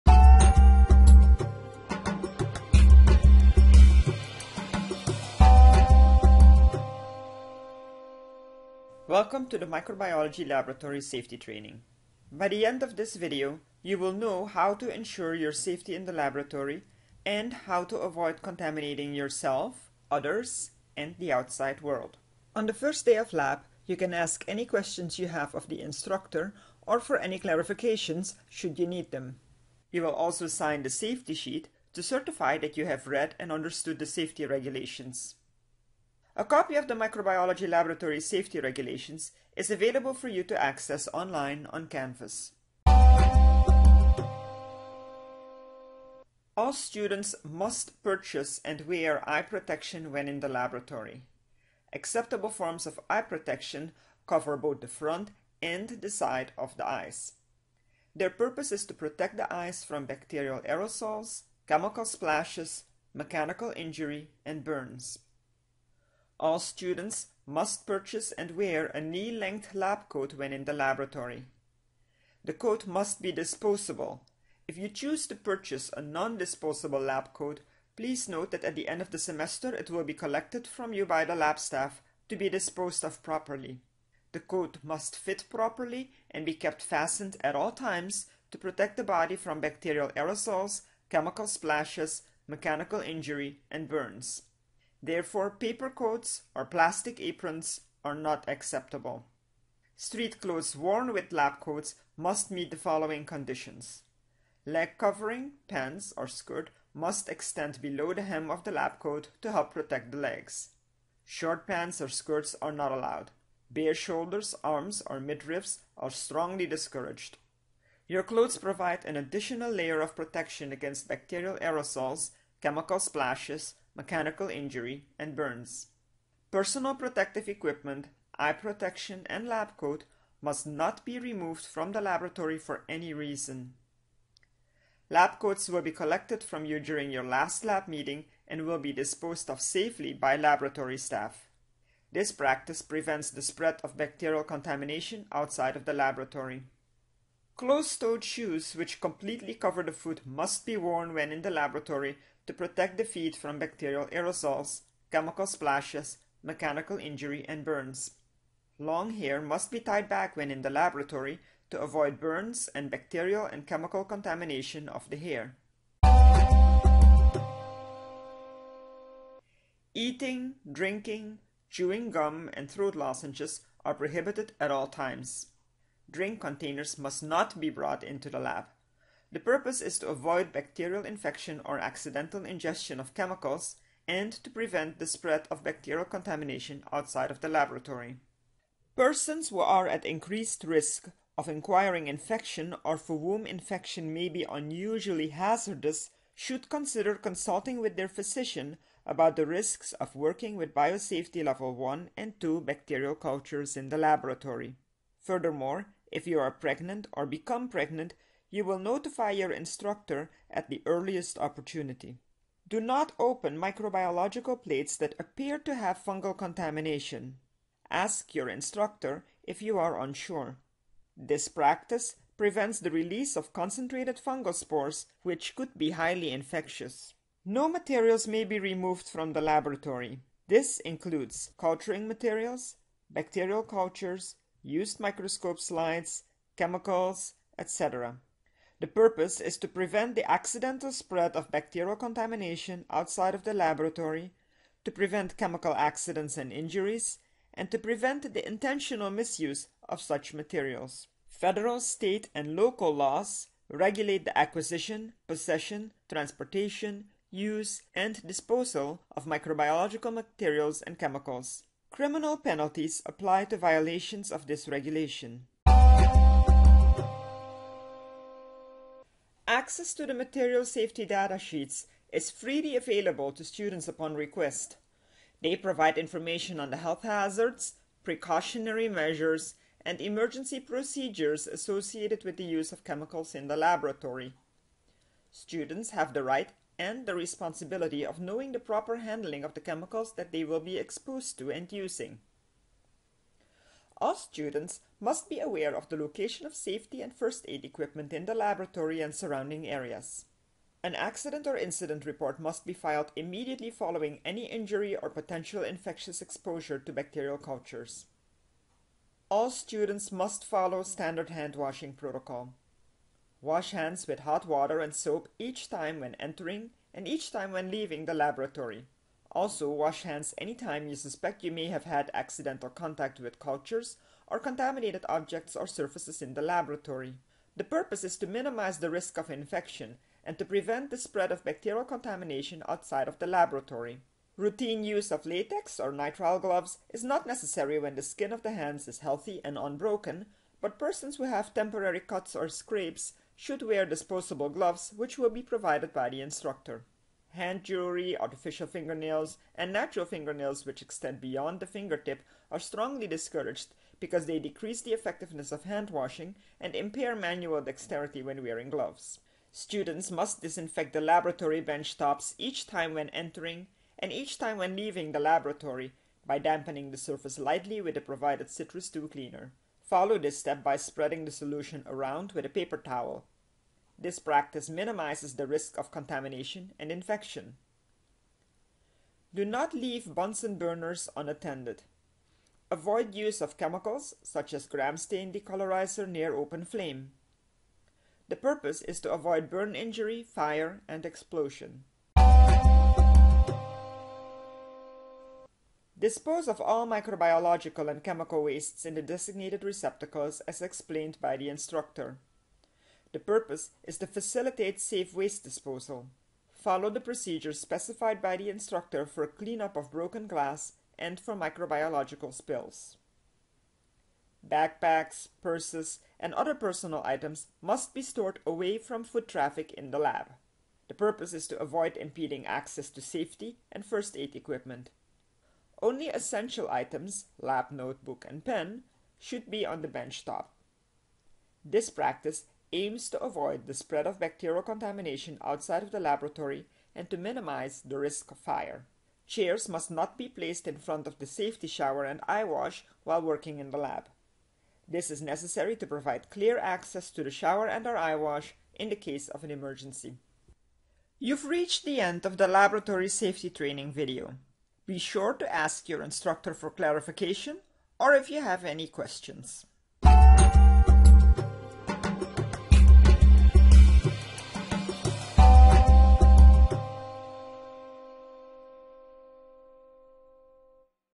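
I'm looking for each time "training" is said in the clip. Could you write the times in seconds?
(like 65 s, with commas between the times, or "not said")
11 s, 453 s.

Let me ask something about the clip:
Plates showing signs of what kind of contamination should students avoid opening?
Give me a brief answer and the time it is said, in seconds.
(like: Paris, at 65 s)
fungal contamination, at 216 s.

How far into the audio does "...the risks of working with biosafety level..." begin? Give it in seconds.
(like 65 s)
199 s.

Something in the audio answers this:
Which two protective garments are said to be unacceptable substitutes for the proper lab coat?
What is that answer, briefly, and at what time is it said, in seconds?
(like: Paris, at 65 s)
paper coats or plastic aprons, at 95 s.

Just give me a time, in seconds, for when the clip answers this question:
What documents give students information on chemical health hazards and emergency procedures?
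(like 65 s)
270 s.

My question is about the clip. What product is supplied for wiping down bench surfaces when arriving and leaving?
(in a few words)
Citrus II cleaner.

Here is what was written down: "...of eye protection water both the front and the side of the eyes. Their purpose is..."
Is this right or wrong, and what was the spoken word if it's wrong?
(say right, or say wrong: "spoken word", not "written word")
wrong: "cover", not "water".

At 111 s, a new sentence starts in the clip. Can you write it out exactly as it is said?
Short pants or skirts are not allowed.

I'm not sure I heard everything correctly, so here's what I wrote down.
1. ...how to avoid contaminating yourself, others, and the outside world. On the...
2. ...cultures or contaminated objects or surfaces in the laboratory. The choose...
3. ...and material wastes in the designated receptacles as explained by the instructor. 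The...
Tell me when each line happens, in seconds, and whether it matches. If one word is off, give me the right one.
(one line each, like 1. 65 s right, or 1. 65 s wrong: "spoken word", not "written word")
1. 17 s right
2. 323 s wrong: "purpose", not "choose"
3. 397 s wrong: "chemical", not "material".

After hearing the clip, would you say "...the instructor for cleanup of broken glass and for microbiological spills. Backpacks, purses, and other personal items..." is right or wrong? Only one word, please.
right.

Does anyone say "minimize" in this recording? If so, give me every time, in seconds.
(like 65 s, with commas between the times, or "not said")
328 s, 374 s, 437 s.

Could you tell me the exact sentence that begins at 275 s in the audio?
They provide information on the health hazards, precautionary measures, and emergency procedures associated with the use of chemicals in the laboratory.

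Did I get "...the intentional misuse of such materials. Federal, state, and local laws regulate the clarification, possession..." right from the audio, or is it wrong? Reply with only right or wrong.
wrong.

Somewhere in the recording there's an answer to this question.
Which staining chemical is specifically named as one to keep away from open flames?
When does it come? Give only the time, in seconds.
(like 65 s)
384 s.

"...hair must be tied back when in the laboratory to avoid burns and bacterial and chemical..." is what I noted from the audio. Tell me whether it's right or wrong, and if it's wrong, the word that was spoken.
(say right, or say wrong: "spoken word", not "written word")
right.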